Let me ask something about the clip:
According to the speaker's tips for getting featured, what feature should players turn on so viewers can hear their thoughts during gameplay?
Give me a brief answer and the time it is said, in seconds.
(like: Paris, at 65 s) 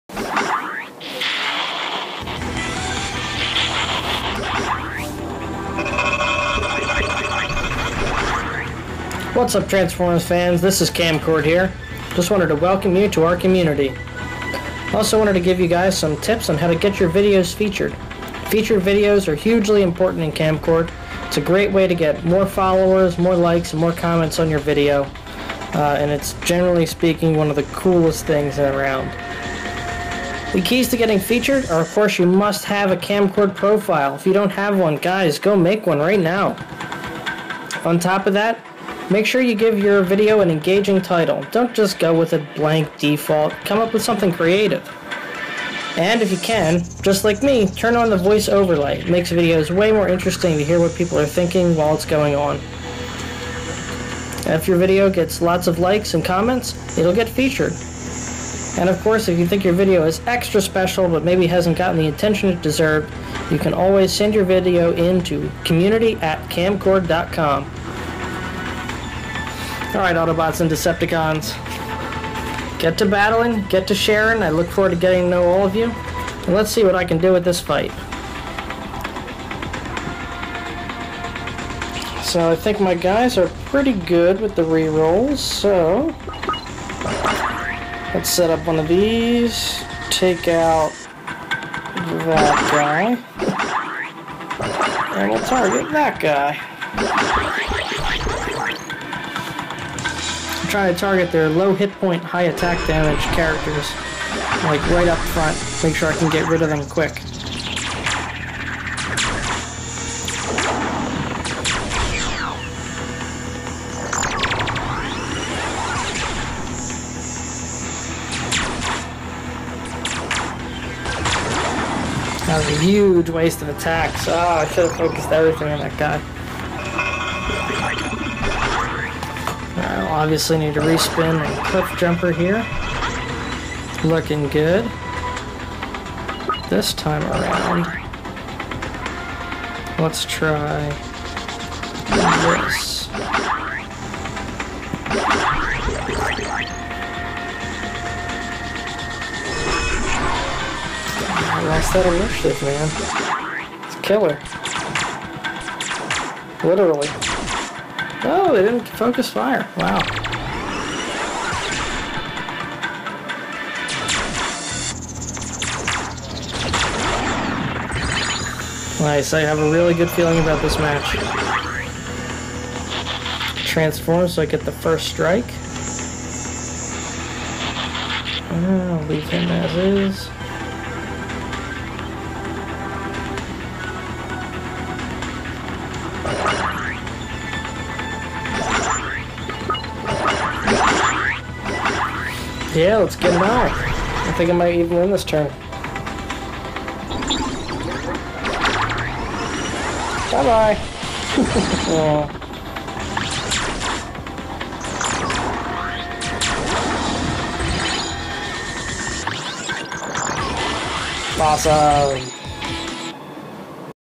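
Voice overlay, at 48 s.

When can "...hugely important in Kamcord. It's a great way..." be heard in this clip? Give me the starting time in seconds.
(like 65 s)
19 s.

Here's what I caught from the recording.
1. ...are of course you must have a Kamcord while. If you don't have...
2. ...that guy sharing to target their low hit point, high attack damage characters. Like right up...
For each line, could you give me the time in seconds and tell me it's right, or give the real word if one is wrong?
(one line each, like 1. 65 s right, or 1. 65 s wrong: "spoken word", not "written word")
1. 31 s wrong: "profile", not "while"
2. 95 s wrong: "trying", not "sharing".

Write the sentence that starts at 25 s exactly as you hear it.
Uh, and it's generally speaking one of the coolest things around.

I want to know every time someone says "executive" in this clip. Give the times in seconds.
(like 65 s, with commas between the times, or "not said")
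not said.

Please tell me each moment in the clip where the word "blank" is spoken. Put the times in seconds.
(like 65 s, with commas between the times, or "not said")
42 s.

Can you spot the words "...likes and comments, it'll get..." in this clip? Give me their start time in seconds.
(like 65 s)
55 s.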